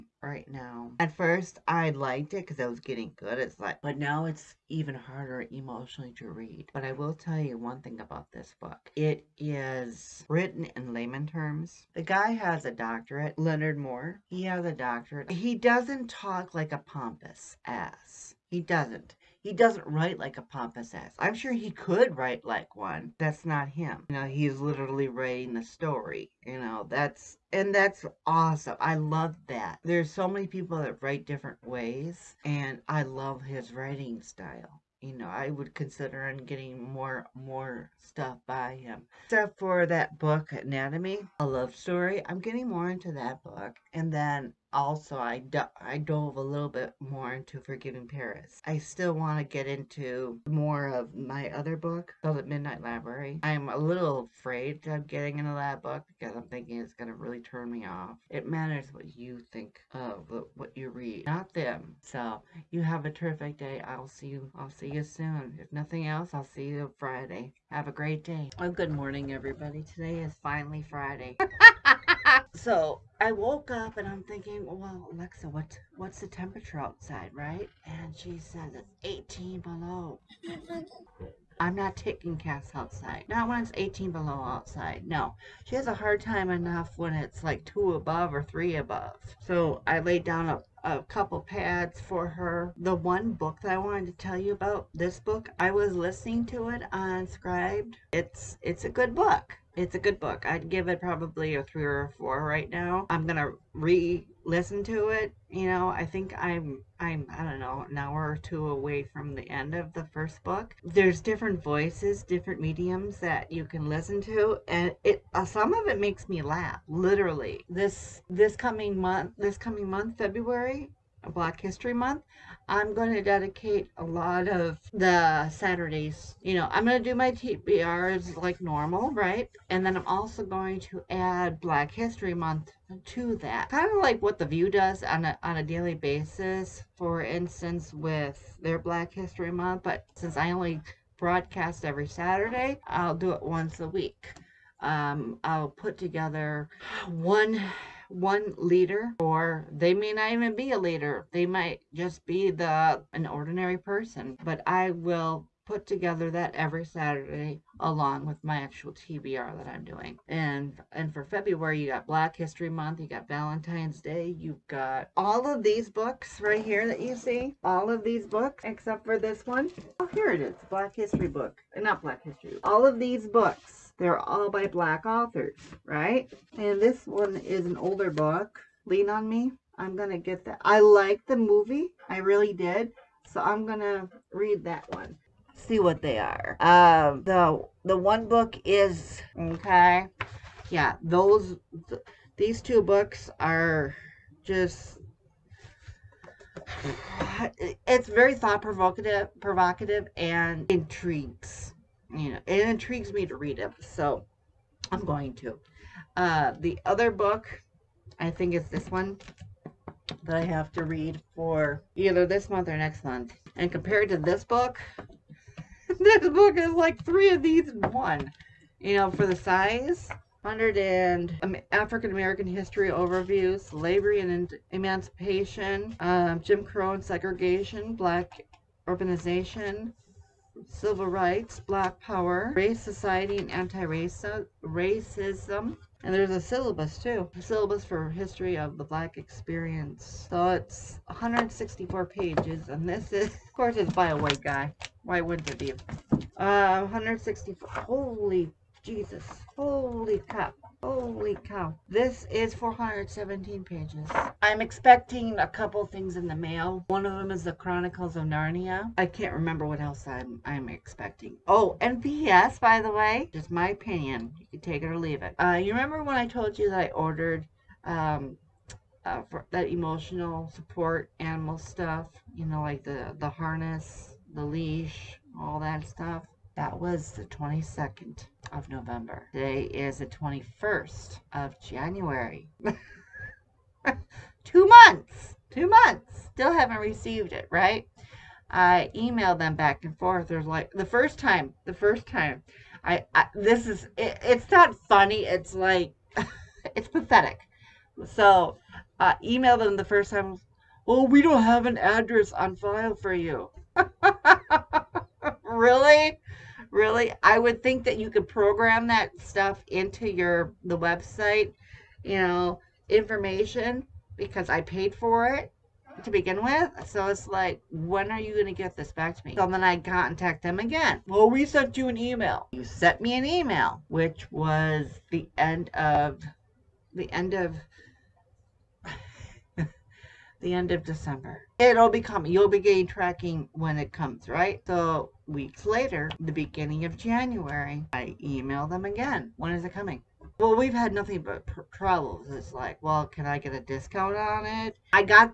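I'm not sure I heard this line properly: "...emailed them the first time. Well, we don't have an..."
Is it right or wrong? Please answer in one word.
right.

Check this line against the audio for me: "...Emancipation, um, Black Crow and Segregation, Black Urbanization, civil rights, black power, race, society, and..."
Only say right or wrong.
wrong.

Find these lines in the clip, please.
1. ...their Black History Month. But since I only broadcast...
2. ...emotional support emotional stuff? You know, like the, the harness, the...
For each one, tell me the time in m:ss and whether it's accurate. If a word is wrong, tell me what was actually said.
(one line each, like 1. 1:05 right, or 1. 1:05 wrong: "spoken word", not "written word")
1. 2:18 right
2. 4:29 wrong: "animal", not "emotional".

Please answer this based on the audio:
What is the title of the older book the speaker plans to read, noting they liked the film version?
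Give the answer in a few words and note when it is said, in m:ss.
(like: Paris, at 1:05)
Lean on Me, at 2:58.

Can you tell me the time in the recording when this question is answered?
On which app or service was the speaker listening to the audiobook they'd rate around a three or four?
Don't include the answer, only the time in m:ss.
1:37.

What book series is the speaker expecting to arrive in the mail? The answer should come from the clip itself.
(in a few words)
Chronicles of Narnia.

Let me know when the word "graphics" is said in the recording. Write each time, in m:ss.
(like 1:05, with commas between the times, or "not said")
not said.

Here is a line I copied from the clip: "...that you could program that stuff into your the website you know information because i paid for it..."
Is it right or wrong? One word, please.
right.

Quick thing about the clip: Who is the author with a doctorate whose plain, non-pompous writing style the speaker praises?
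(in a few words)
Leonard Moore.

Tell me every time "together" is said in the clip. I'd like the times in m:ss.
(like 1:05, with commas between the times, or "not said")
2:25, 2:35.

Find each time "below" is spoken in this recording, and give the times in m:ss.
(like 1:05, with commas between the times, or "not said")
1:19, 1:24.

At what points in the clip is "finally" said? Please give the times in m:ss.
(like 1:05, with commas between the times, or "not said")
1:10.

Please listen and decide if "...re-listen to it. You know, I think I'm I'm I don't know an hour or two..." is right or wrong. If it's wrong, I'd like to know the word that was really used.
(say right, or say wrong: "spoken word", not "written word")
right.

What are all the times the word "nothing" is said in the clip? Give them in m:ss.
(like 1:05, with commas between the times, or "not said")
1:05, 5:40.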